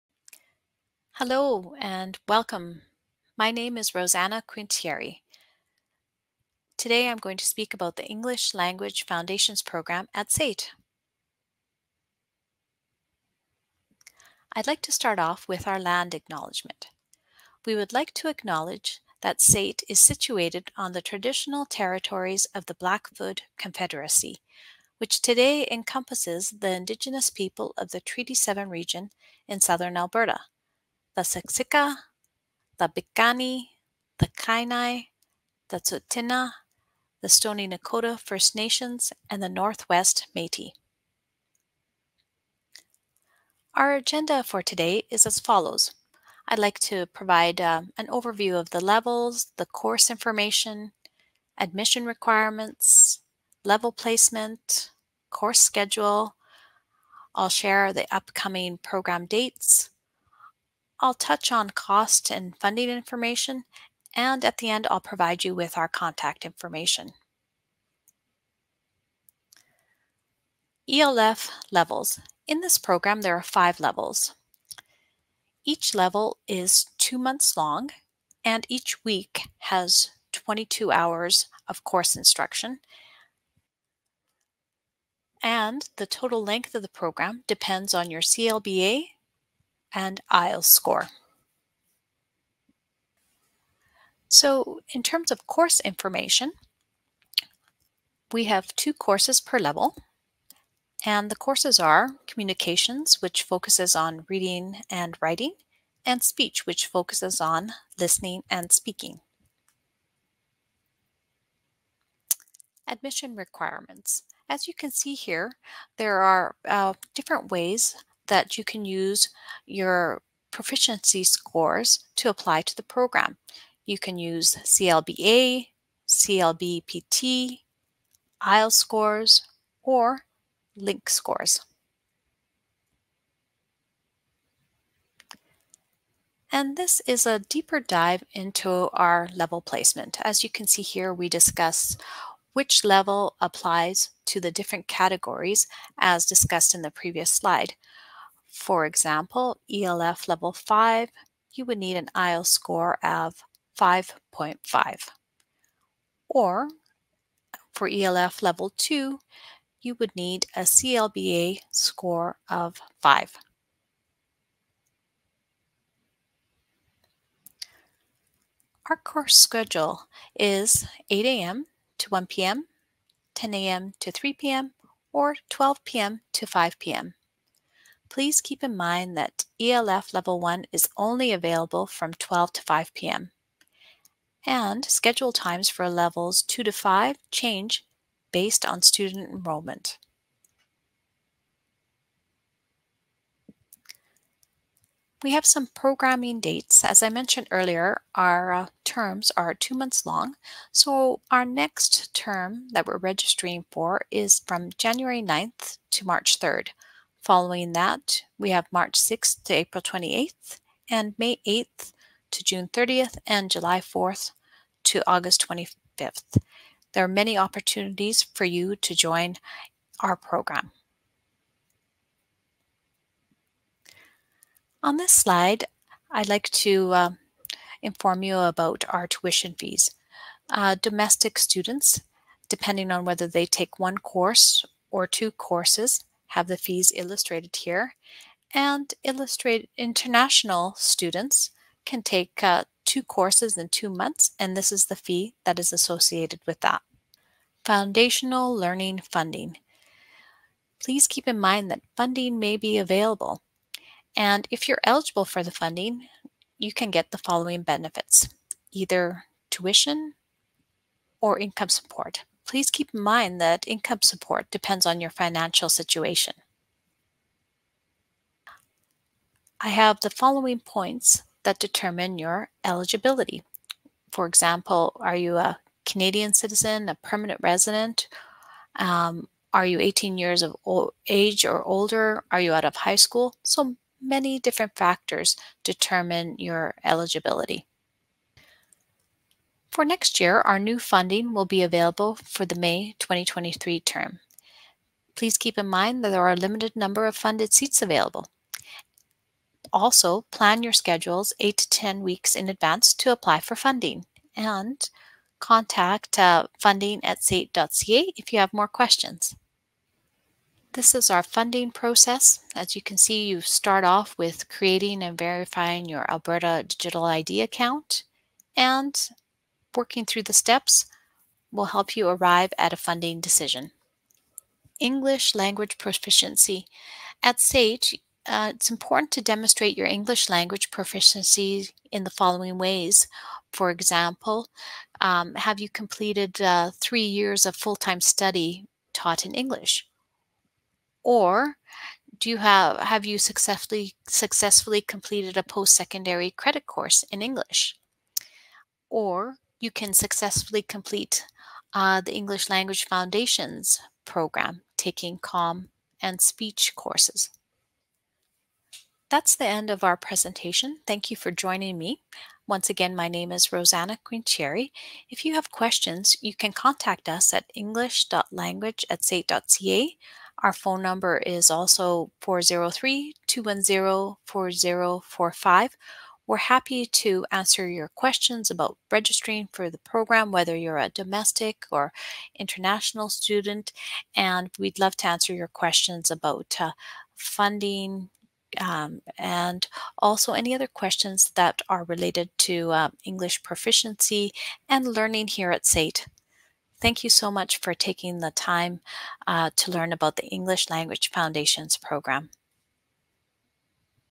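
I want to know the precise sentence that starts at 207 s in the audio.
Following that, we have March 6th to April 28th, and May 8th to June 30th, and July 4th to August 25th.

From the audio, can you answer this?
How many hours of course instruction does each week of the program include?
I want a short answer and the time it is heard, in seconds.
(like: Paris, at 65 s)
22, at 80 s.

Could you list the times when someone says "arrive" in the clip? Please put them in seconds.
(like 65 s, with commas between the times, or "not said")
322 s.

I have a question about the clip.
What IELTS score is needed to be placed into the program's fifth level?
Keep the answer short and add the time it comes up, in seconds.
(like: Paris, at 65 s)
5.5, at 153 s.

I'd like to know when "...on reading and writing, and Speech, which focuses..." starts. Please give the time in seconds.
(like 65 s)
103 s.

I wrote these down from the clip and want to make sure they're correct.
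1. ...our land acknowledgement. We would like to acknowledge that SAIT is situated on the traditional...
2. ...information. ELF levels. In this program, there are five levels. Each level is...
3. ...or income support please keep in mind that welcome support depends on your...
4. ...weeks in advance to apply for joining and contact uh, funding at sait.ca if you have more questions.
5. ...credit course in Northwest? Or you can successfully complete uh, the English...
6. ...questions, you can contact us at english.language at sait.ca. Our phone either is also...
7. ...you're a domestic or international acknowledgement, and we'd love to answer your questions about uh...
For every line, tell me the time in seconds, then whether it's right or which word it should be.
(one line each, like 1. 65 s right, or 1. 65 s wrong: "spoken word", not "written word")
1. 15 s right
2. 66 s right
3. 261 s wrong: "income", not "welcome"
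4. 302 s wrong: "funding", not "joining"
5. 346 s wrong: "English", not "Northwest"
6. 365 s wrong: "number", not "either"
7. 380 s wrong: "student", not "acknowledgement".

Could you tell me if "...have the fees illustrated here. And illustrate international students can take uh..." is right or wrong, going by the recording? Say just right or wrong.
right.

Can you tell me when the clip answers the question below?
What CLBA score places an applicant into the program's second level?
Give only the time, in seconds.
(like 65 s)
160 s.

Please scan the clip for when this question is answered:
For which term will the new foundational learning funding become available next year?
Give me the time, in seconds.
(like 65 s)
292 s.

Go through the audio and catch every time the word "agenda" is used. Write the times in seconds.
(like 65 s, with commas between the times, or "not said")
43 s.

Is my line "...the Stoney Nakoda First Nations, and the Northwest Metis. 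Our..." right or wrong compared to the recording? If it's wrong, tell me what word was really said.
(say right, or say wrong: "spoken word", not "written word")
right.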